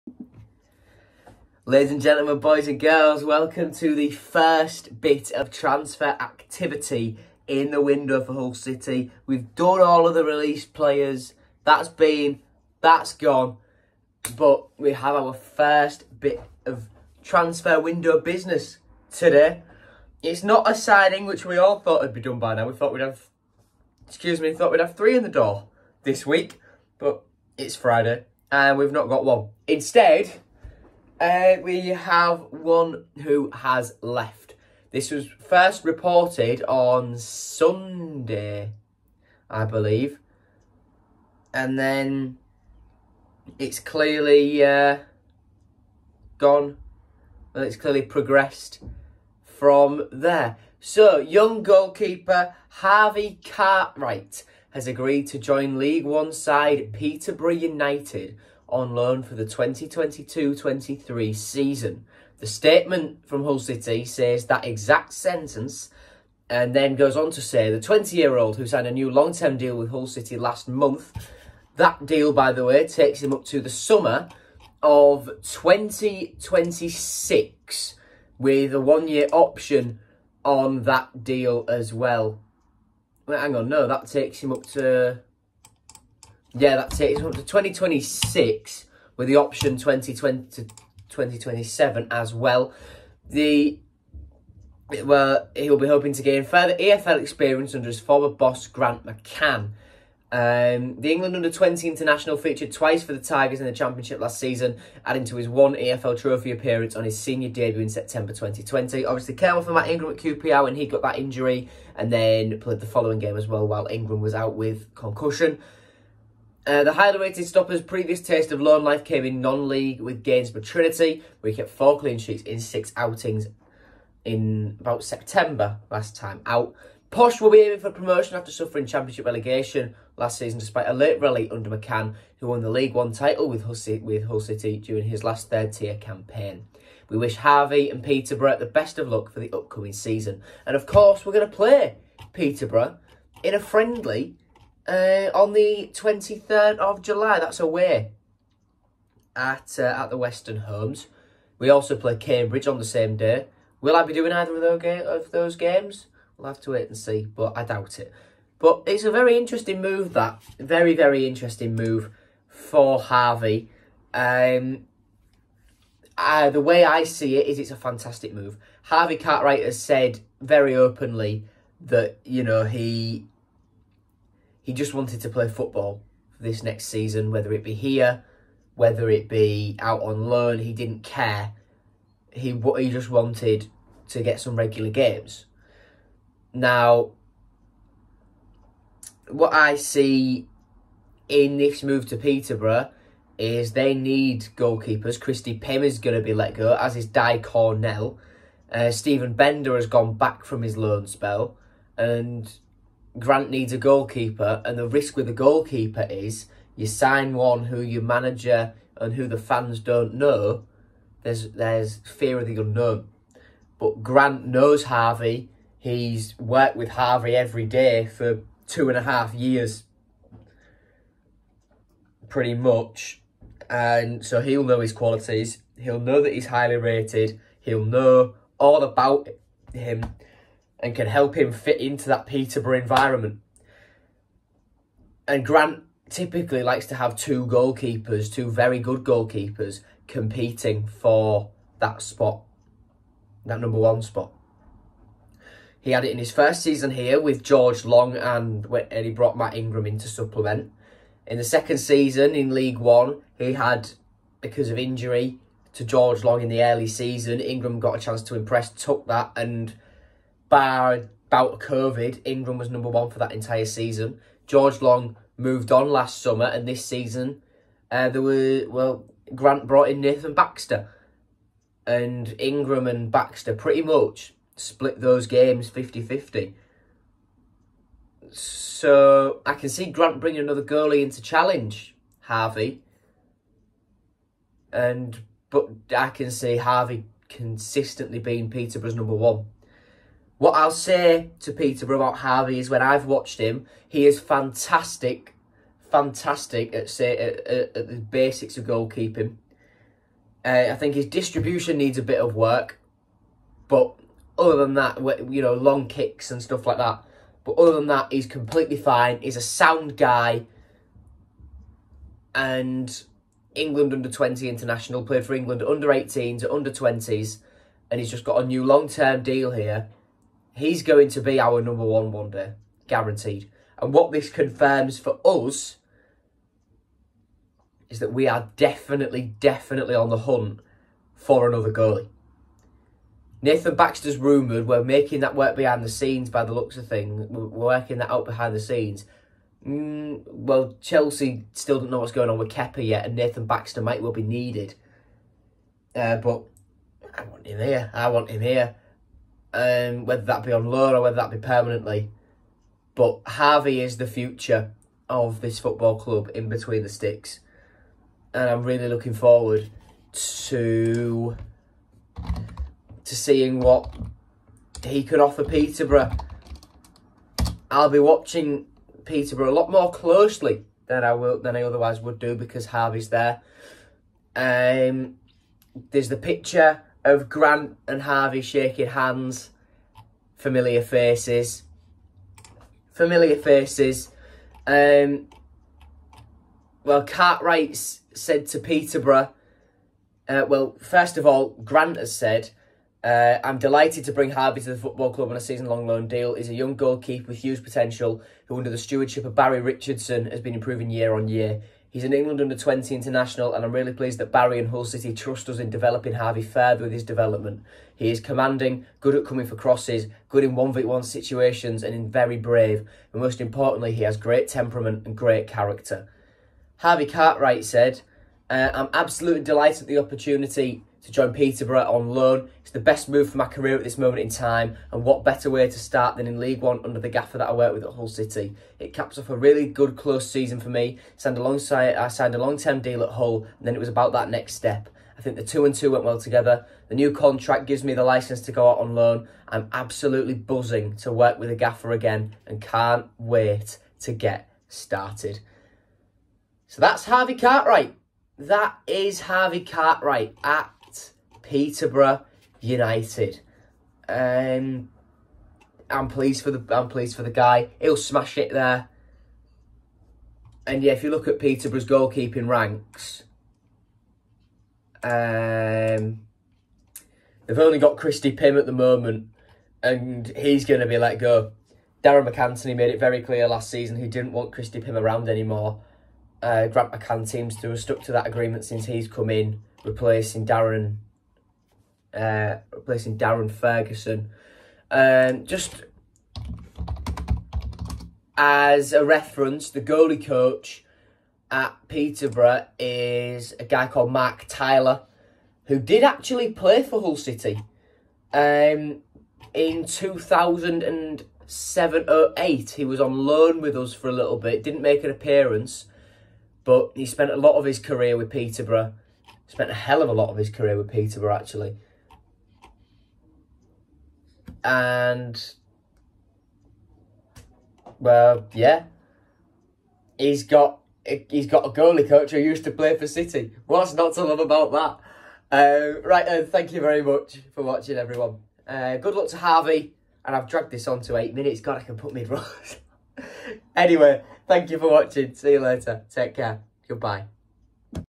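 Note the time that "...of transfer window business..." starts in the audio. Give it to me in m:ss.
0:16.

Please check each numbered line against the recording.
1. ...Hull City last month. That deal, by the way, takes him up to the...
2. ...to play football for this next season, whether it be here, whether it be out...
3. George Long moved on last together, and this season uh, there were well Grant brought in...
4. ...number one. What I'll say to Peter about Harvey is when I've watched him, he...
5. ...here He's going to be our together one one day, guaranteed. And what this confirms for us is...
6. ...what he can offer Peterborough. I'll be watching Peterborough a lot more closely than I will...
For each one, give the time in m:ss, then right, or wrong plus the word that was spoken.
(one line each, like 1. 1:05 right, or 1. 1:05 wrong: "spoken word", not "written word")
1. 1:09 right
2. 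2:55 right
3. 4:24 wrong: "summer", not "together"
4. 4:48 right
5. 5:19 wrong: "number", not "together"
6. 6:03 right.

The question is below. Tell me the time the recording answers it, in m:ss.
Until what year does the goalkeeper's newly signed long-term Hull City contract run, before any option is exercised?
1:27.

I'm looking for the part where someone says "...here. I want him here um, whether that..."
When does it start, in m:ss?
5:47.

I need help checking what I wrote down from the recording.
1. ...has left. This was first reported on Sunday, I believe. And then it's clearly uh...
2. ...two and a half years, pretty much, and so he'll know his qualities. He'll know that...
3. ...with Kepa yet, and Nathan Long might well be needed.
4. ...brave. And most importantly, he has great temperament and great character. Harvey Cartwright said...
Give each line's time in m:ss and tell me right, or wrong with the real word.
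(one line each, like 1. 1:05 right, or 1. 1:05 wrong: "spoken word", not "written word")
1. 0:33 right
2. 3:38 right
3. 5:42 wrong: "Baxter", not "Long"
4. 6:52 right.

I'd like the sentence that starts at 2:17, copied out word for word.
We wish Harvey and Peterborough the best of luck for the upcoming season.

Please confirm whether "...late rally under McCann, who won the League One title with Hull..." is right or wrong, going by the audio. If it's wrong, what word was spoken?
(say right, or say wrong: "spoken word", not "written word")
right.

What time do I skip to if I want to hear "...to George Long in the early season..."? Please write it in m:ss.
4:15.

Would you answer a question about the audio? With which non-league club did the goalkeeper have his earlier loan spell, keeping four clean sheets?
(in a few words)
Gainsborough Trinity.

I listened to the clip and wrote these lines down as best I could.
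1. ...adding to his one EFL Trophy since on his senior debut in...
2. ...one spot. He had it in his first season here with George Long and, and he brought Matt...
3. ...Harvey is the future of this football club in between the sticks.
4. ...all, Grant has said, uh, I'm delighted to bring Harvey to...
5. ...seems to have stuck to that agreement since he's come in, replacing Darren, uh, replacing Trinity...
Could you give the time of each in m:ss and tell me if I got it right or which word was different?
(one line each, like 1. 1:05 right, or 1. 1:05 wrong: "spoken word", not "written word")
1. 1:45 wrong: "appearance", not "since"
2. 4:03 right
3. 5:53 right
4. 6:31 right
5. 7:57 wrong: "Darren", not "Trinity".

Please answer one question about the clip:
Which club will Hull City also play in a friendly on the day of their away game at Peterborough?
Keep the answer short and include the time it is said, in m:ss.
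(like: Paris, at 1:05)
Cambridge, at 2:32.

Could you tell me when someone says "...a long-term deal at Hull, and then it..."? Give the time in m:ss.
7:12.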